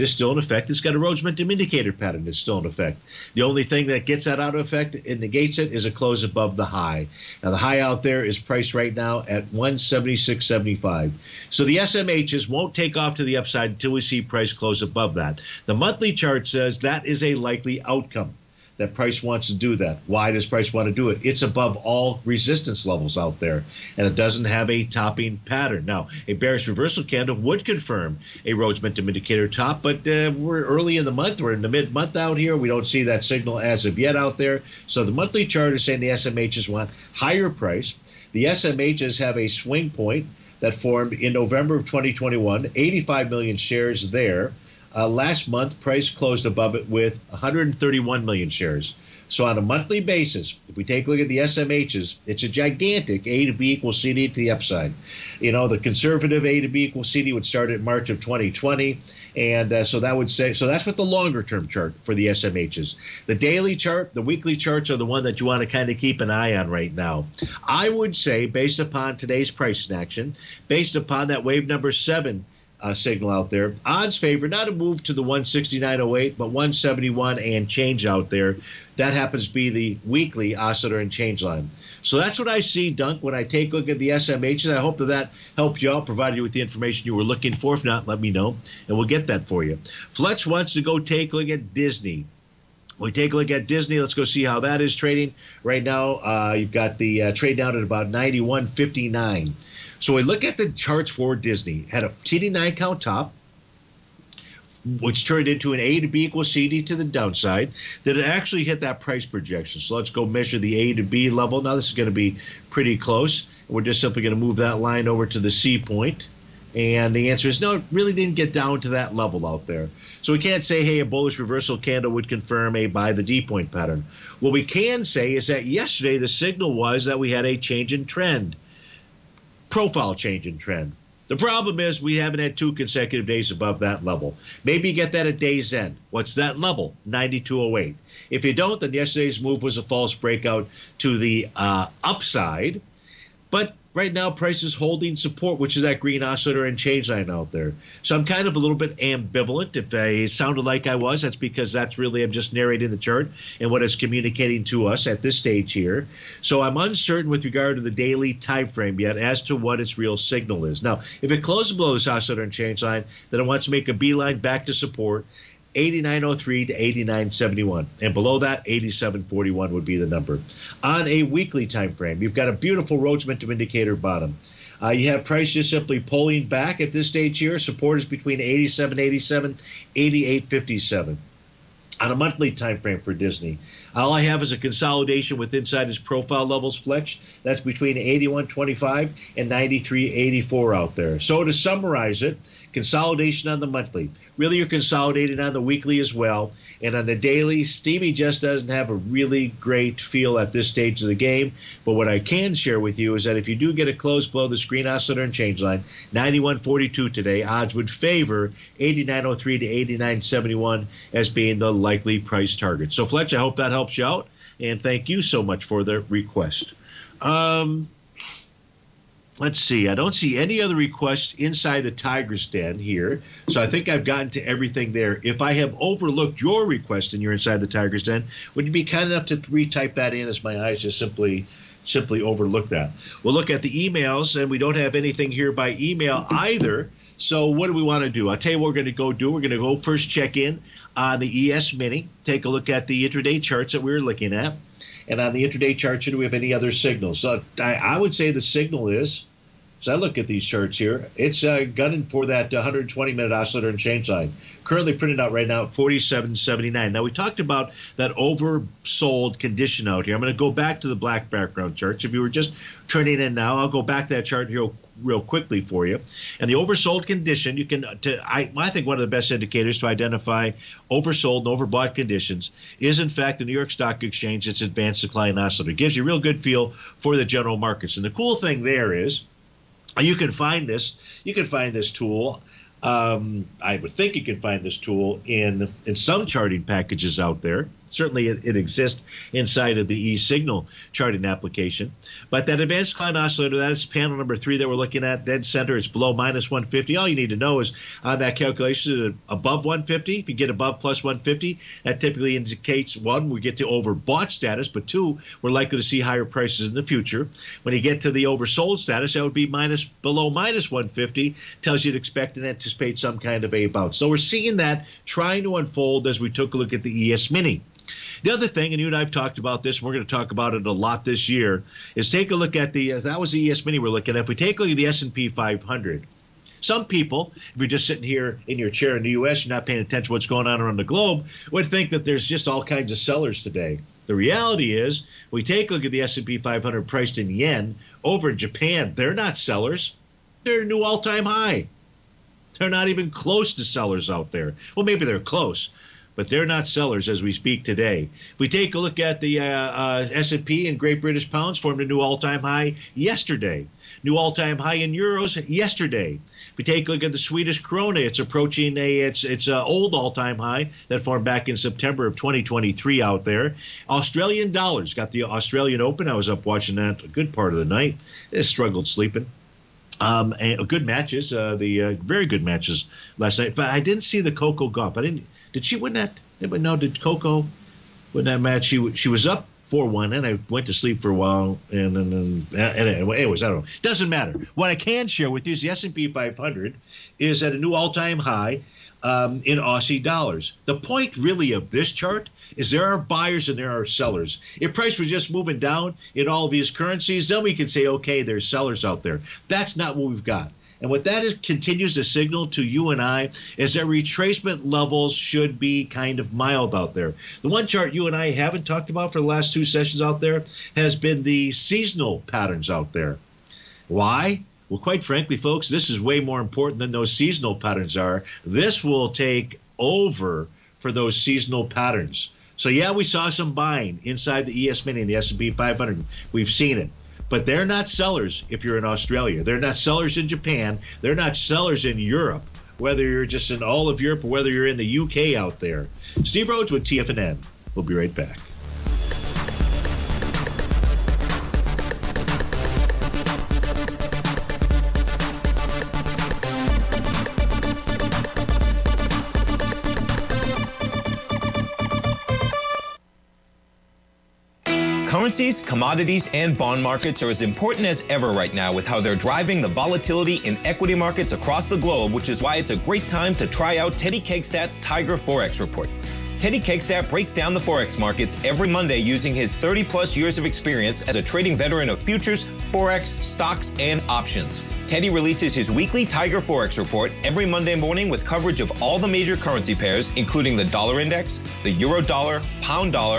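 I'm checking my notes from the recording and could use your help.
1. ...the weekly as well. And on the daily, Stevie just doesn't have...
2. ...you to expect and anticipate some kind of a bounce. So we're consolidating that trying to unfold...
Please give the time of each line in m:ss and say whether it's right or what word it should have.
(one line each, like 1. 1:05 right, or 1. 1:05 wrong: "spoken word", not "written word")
1. 3:15 right
2. 5:11 wrong: "seeing", not "consolidating".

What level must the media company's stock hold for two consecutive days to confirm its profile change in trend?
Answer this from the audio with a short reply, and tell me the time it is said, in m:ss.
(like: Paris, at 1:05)
92.08, at 2:17.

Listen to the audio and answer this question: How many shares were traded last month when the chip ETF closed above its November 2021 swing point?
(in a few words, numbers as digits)
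131 million.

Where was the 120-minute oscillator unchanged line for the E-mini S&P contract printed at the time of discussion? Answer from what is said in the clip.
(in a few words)
47.79.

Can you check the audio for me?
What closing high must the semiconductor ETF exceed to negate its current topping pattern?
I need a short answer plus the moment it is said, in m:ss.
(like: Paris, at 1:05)
176.75, at 0:09.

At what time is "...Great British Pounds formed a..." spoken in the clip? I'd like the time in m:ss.
5:50.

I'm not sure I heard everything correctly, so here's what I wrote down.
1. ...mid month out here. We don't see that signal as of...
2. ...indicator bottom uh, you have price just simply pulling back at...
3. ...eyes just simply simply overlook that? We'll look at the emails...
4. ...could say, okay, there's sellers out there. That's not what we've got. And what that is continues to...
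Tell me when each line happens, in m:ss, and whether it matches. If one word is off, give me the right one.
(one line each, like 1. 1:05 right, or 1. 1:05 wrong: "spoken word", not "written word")
1. 0:31 right
2. 2:53 right
3. 3:50 right
4. 6:37 right.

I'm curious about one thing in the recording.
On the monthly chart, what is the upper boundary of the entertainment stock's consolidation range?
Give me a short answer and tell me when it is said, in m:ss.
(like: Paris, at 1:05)
93.84, at 3:09.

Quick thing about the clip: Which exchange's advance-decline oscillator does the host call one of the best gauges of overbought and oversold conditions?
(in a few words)
New York Stock Exchange.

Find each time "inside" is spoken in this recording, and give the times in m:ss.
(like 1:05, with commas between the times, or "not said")
3:05, 3:41, 3:47, 4:49, 7:04.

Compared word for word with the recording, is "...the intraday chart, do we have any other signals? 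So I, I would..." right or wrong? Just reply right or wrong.
right.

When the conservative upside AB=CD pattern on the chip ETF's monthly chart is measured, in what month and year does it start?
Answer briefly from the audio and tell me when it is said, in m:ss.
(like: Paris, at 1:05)
March 2020, at 0:57.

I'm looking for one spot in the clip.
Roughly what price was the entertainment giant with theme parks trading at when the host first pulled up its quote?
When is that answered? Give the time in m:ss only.
1:38.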